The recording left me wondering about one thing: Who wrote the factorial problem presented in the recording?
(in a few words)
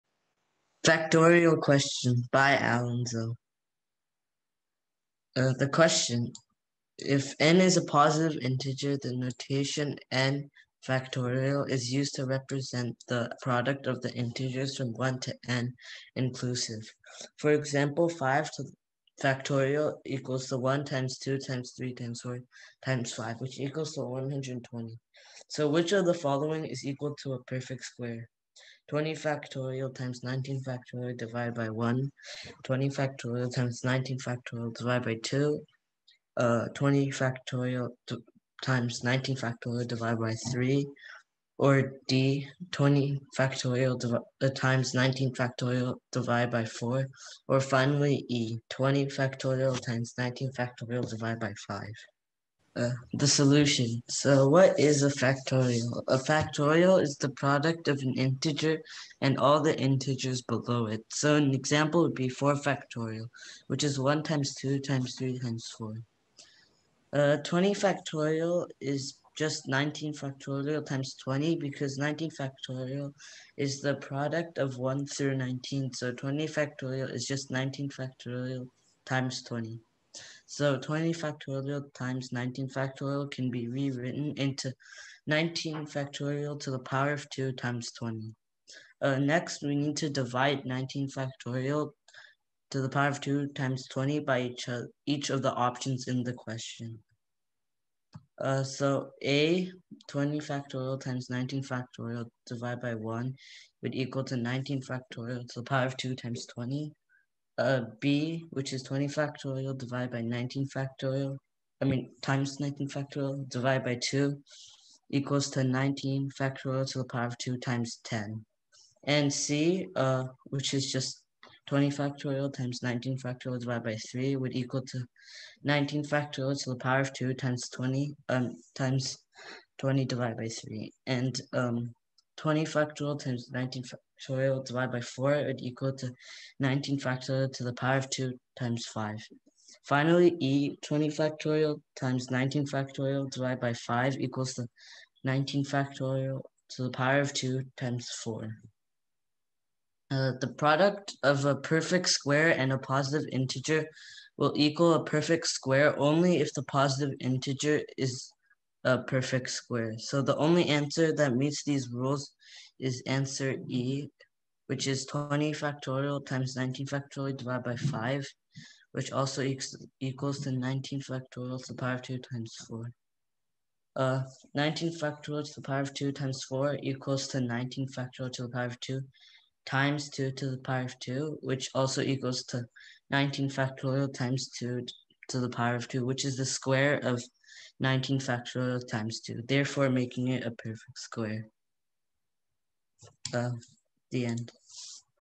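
Allan Zhou.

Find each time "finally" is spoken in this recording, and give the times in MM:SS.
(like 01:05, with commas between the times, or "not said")
00:47, 02:19.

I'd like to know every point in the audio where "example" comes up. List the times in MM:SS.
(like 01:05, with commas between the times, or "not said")
00:17, 01:01.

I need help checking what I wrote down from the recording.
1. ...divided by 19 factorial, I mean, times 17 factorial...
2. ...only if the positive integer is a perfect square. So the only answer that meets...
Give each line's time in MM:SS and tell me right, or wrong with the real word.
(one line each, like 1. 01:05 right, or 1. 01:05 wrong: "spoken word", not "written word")
1. 01:49 wrong: "19", not "17"
2. 02:35 right.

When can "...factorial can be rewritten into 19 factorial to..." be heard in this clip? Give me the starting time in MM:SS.
01:22.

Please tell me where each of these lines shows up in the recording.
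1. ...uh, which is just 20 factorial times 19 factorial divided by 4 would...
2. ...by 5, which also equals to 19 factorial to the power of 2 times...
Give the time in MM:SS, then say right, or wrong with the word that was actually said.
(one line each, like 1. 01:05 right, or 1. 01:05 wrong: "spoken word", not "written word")
1. 01:59 wrong: "3", not "4"
2. 02:47 right.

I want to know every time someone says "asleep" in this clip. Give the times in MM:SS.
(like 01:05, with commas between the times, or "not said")
not said.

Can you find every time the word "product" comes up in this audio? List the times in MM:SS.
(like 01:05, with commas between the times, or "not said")
00:13, 00:57, 01:13, 02:30.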